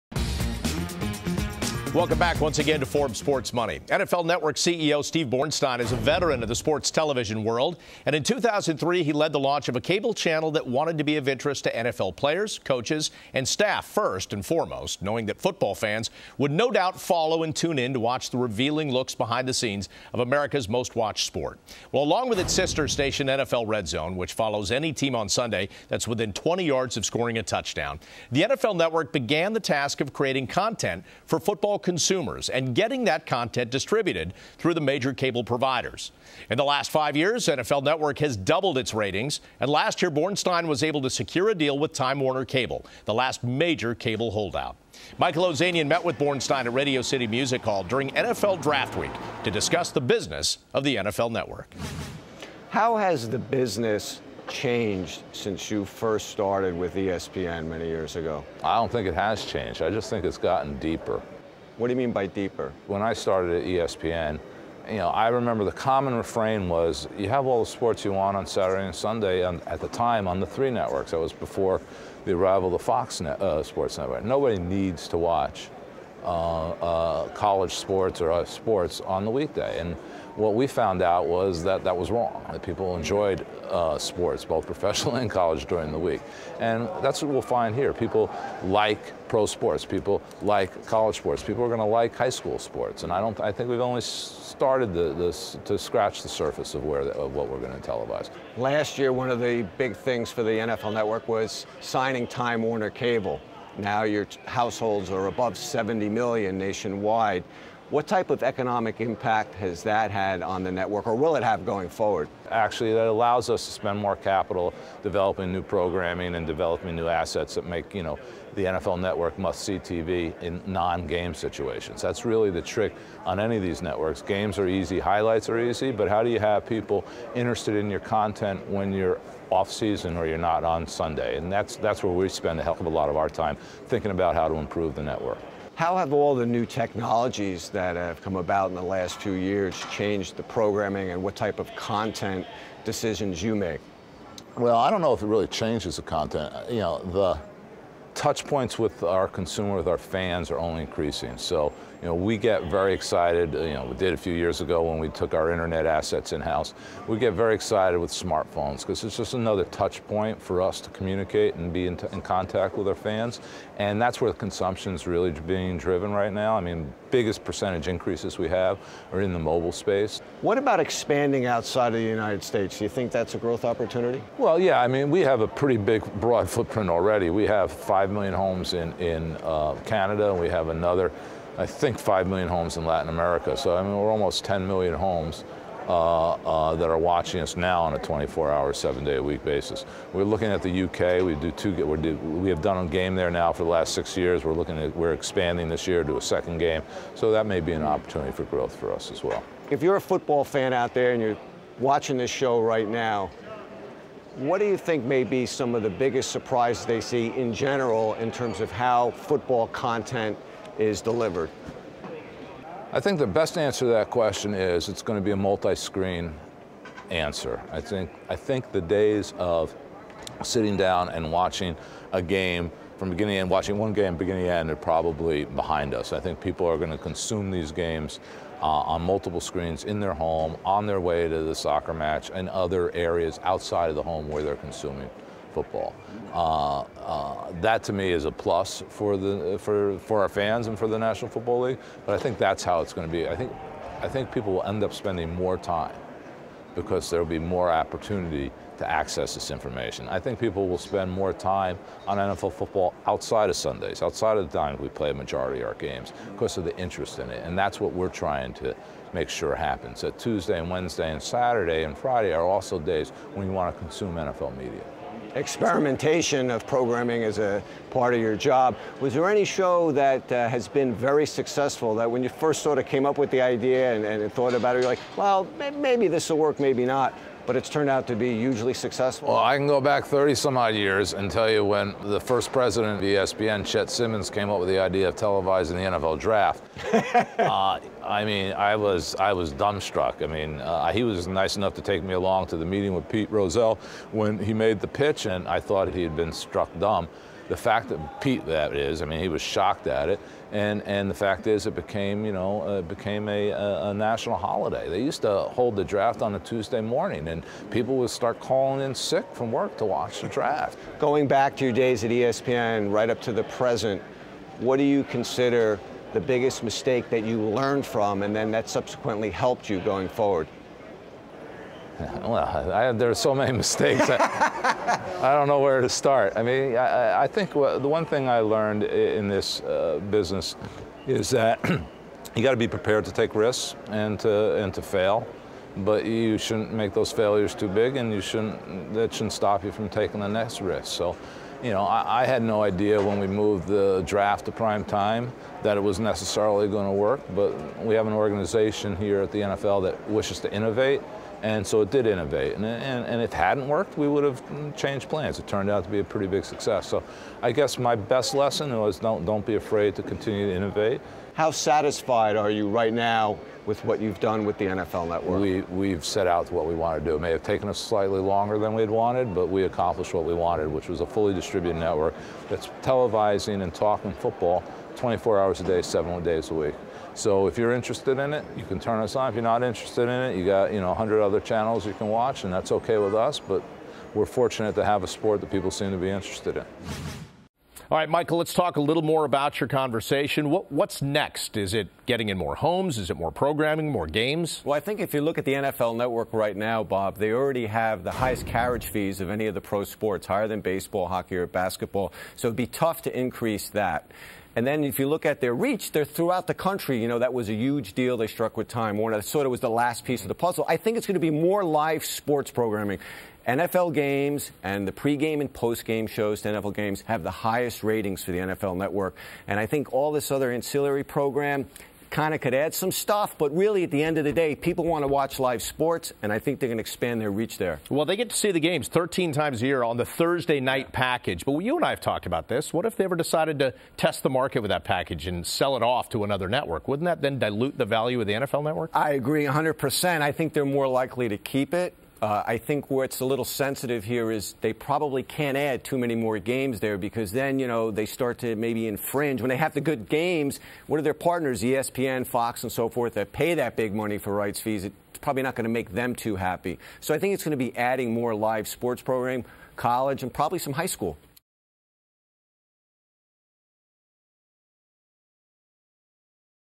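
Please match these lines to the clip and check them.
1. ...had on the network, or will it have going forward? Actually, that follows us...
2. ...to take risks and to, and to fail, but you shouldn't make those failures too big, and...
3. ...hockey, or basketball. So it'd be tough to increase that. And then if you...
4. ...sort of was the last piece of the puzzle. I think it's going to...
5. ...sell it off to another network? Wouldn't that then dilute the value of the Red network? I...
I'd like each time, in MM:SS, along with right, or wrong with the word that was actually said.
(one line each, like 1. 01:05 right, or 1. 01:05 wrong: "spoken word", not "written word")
1. 01:50 wrong: "allows", not "follows"
2. 05:33 right
3. 06:41 right
4. 06:49 right
5. 07:15 wrong: "NFL", not "Red".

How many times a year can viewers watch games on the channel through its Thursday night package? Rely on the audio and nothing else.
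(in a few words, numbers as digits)
13.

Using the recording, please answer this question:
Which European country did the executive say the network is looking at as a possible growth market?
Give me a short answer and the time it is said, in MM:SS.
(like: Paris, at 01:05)
UK, at 03:10.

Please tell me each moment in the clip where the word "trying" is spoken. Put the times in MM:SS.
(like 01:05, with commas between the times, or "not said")
04:18.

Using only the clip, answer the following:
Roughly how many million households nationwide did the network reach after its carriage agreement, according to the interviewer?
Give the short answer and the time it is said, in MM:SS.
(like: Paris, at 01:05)
70 million, at 01:45.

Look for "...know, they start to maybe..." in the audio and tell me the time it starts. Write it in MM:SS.
07:27.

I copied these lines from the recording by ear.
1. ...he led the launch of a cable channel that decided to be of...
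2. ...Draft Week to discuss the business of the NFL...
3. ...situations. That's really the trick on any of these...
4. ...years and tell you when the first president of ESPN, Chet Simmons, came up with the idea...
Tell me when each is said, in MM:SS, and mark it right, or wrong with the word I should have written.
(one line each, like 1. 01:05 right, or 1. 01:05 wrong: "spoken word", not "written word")
1. 00:09 wrong: "wanted", not "decided"
2. 00:48 right
3. 02:01 right
4. 04:40 right.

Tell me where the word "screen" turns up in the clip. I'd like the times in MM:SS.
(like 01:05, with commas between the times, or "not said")
03:35, 03:49.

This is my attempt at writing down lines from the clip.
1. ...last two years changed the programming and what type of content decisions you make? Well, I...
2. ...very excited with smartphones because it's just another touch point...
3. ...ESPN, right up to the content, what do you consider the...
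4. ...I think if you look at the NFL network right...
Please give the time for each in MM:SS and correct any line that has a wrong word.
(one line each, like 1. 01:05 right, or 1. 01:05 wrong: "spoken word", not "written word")
1. 02:18 right
2. 02:37 right
3. 05:12 wrong: "present", not "content"
4. 06:34 right.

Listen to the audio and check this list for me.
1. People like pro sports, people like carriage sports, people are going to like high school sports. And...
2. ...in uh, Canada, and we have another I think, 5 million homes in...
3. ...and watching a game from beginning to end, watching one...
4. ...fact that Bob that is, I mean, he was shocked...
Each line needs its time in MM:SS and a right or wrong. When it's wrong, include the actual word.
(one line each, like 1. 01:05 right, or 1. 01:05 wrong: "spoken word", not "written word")
1. 01:27 wrong: "college", not "carriage"
2. 02:58 right
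3. 03:41 right
4. 04:57 wrong: "Pete", not "Bob".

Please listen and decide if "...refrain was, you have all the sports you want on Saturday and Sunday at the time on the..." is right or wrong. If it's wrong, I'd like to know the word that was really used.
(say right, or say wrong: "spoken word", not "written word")
right.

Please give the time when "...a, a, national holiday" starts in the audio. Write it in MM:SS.
05:03.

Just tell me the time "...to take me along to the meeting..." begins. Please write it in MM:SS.
04:51.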